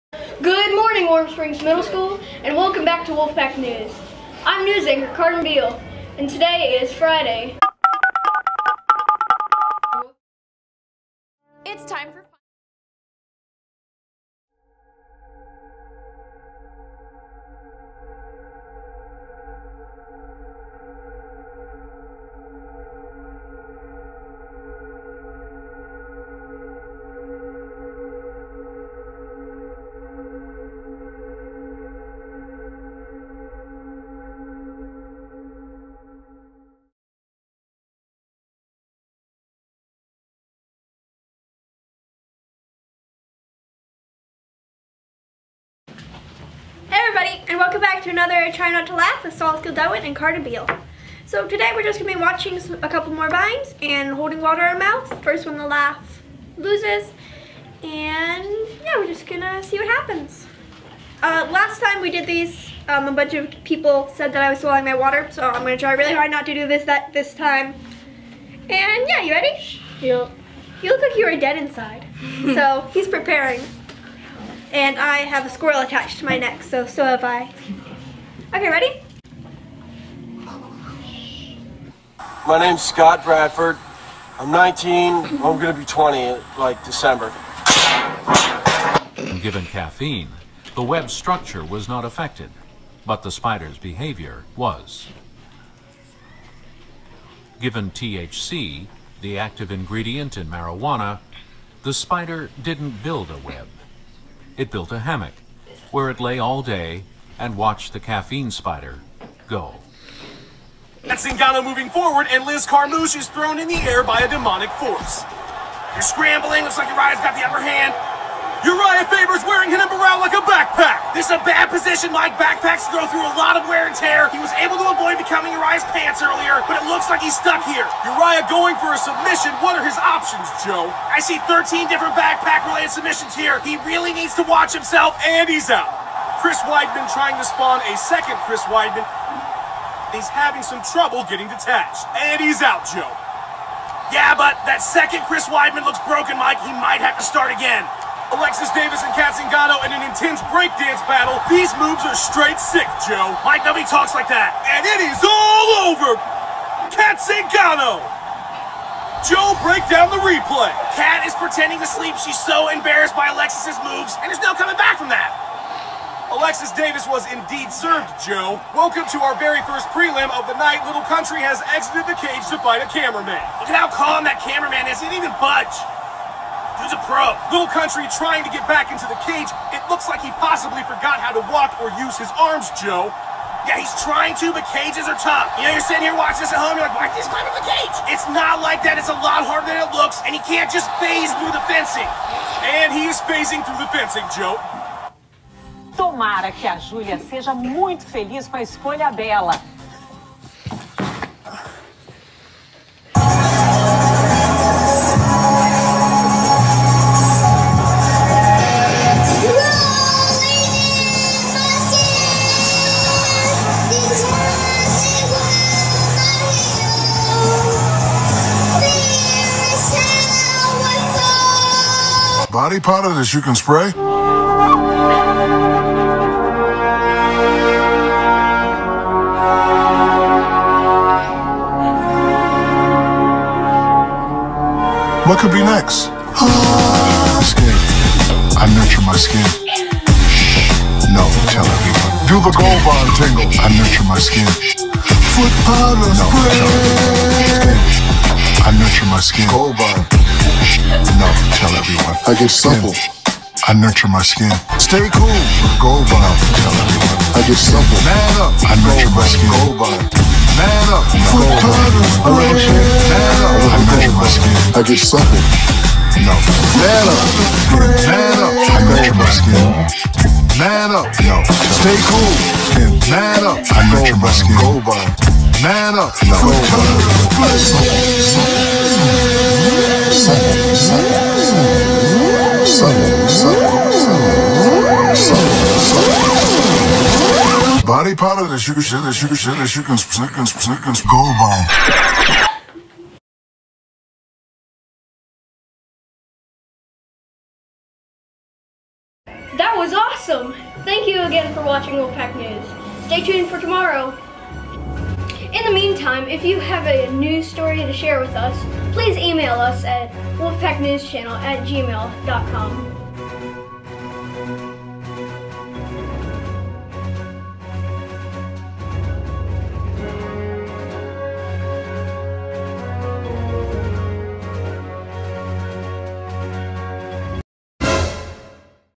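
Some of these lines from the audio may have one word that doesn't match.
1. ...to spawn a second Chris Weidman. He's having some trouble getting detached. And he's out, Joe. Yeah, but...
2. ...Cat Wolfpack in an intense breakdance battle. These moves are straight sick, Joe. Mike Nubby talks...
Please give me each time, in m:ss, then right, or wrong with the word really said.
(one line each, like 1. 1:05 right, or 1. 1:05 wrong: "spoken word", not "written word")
1. 2:17 right
2. 2:29 wrong: "Zingano", not "Wolfpack".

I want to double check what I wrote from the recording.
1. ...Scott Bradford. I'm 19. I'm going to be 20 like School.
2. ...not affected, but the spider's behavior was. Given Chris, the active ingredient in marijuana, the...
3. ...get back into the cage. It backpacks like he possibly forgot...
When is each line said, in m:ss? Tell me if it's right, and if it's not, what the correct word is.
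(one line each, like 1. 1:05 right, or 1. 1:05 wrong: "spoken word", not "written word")
1. 1:22 wrong: "December", not "School"
2. 1:31 wrong: "THC", not "Chris"
3. 2:58 wrong: "looks", not "backpacks".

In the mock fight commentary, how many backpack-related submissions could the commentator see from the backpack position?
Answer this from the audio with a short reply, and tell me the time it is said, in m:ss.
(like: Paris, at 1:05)
13, at 2:11.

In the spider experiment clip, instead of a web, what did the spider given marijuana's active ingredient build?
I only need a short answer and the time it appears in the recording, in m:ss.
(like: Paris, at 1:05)
a hammock, at 1:44.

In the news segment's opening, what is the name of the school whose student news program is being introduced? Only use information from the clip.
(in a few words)
Warm Springs Middle School.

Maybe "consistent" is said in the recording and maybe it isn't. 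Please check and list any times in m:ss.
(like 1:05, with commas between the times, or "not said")
not said.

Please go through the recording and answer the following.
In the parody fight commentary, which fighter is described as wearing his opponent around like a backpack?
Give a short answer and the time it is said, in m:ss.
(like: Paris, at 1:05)
Uriah Faber, at 1:58.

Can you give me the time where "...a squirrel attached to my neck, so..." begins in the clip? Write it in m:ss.
1:15.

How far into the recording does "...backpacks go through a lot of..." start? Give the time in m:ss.
2:02.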